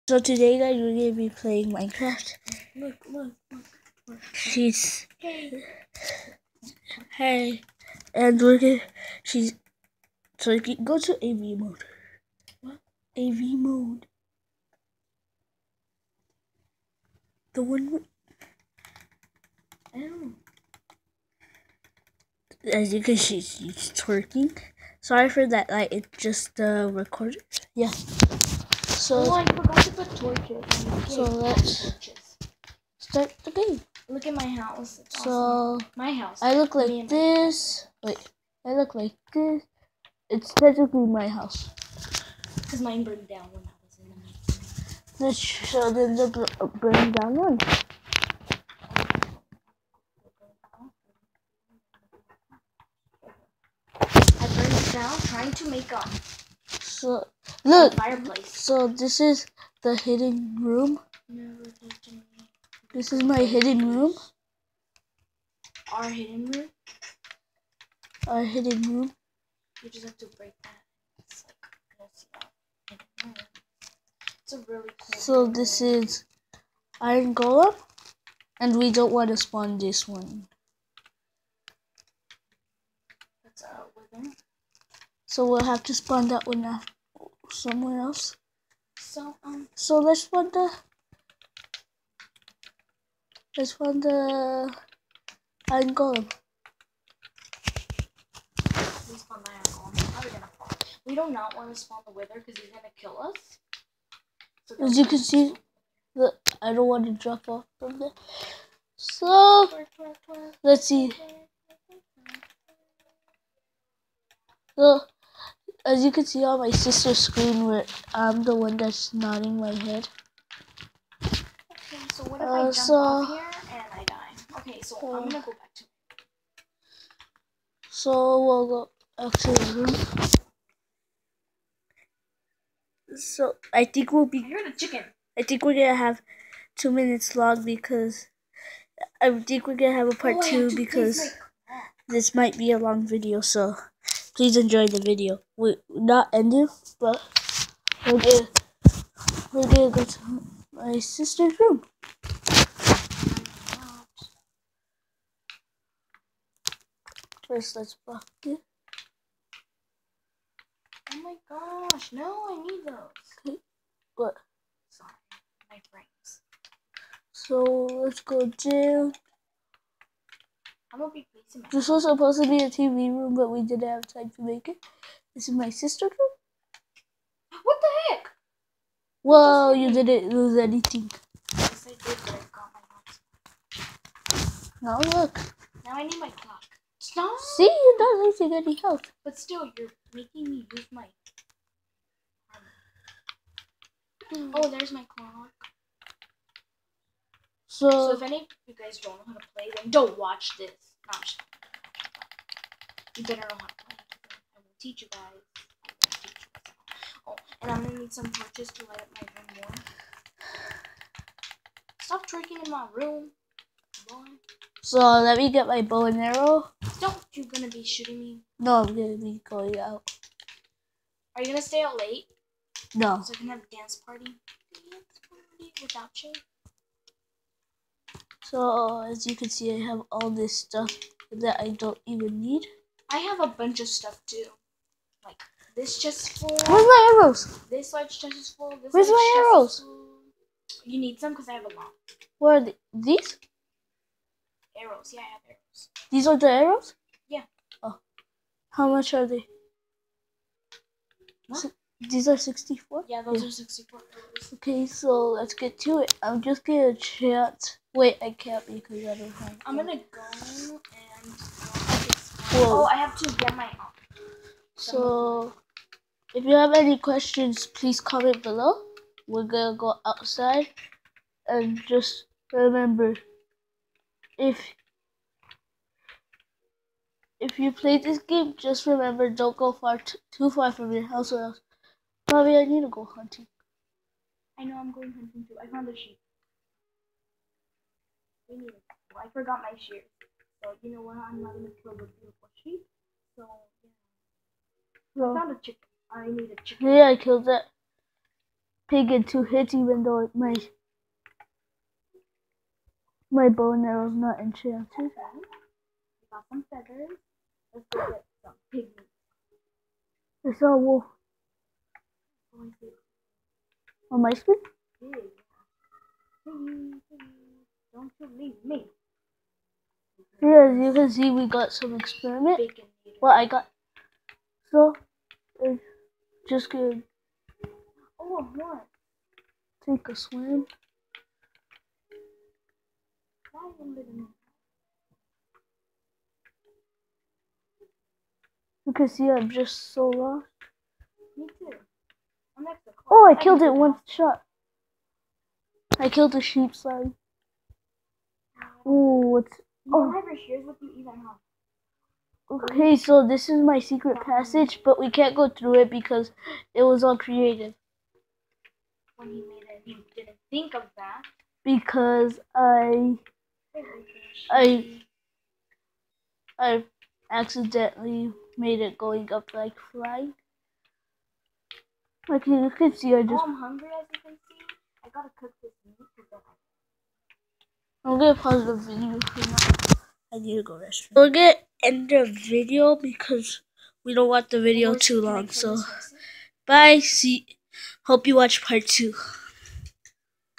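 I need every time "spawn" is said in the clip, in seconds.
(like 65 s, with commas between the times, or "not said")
79 s, 85 s, 101 s.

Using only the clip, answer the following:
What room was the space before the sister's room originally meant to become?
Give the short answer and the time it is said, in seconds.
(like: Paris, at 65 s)
TV room, at 172 s.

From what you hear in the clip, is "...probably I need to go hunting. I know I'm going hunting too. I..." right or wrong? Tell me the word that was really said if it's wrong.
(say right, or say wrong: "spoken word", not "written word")
right.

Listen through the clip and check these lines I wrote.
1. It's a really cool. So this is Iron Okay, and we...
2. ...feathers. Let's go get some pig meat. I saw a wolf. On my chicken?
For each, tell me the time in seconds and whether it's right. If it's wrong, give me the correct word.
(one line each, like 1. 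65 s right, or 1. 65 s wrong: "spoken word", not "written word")
1. 74 s wrong: "Golem", not "Okay"
2. 306 s wrong: "screen", not "chicken".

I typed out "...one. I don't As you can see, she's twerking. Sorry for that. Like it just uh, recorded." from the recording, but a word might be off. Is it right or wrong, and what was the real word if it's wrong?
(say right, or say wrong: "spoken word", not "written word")
right.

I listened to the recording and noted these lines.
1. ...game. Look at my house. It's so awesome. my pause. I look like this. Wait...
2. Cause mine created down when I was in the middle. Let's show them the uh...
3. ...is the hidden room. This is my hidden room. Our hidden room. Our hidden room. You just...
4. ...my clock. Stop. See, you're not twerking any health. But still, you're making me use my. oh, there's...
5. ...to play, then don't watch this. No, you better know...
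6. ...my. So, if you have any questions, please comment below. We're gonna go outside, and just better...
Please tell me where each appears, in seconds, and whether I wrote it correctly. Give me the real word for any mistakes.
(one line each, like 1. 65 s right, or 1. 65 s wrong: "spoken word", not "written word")
1. 33 s wrong: "house", not "pause"
2. 42 s wrong: "burned", not "created"
3. 59 s right
4. 186 s wrong: "losing", not "twerking"
5. 199 s right
6. 263 s wrong: "remember", not "better".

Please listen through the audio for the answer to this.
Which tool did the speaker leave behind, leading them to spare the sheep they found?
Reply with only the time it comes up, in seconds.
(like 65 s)
289 s.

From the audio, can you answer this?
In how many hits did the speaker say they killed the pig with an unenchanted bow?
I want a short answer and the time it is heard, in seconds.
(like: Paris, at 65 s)
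2, at 299 s.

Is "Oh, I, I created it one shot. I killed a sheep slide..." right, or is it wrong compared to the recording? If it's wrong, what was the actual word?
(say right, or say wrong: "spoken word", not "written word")
wrong: "killed", not "created".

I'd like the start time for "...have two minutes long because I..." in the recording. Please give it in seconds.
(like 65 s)
135 s.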